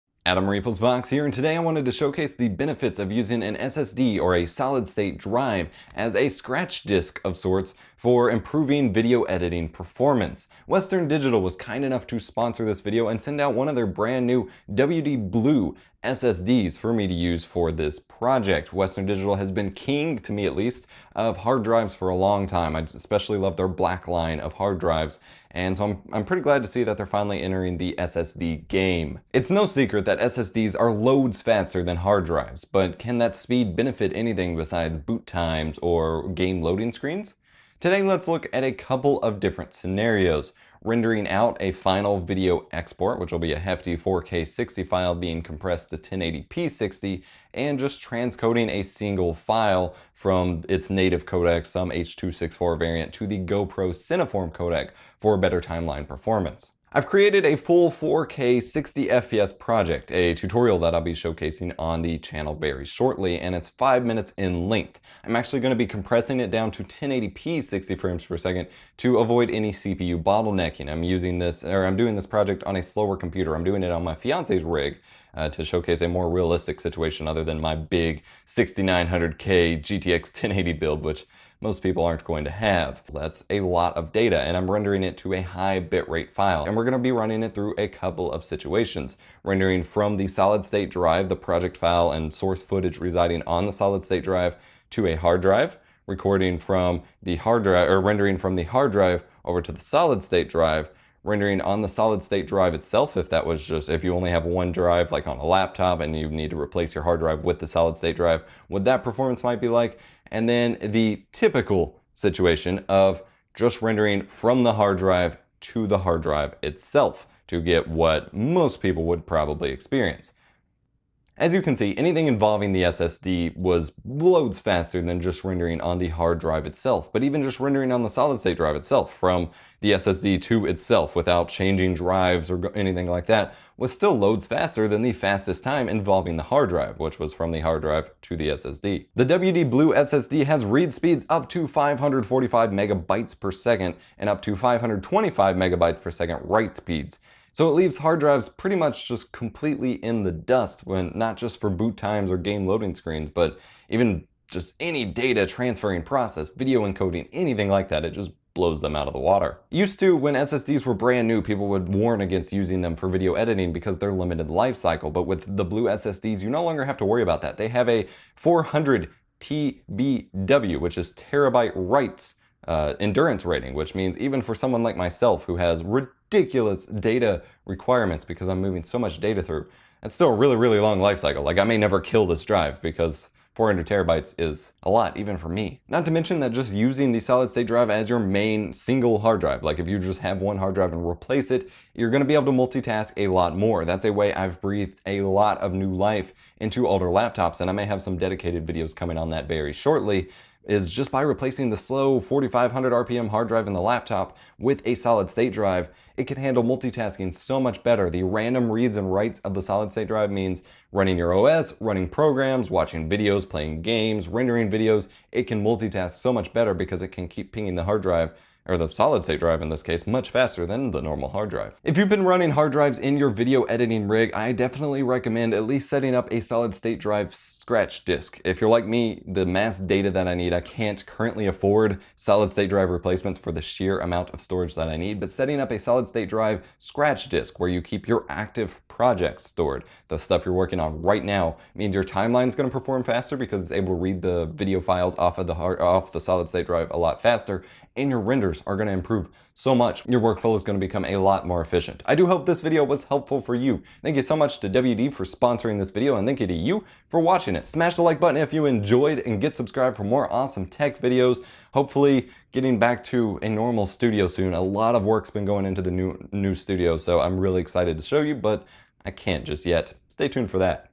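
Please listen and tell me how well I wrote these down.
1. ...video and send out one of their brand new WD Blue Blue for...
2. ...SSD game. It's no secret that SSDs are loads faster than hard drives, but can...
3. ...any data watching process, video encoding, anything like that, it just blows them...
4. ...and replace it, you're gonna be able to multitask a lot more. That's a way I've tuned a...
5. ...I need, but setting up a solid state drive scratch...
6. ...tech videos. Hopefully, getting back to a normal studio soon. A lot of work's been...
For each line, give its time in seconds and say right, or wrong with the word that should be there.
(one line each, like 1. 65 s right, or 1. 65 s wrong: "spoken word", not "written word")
1. 12 s wrong: "SSDs", not "Blue"
2. 27 s right
3. 154 s wrong: "transferring", not "watching"
4. 190 s wrong: "breathed", not "tuned"
5. 234 s right
6. 260 s right.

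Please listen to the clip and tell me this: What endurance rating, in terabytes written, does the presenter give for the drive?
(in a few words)
400 TBW.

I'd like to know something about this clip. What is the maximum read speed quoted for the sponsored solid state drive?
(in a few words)
545 megabytes per second.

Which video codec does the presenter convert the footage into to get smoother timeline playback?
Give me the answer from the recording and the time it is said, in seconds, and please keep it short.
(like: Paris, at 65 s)
GoPro Cineform, at 53 s.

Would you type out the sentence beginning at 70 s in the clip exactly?
I'm using this, or I'm doing this project on a slower computer.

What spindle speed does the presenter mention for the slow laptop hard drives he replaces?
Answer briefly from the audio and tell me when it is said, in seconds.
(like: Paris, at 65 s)
4500 RPM, at 202 s.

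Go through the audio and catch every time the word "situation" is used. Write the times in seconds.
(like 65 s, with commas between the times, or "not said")
76 s, 88 s, 112 s.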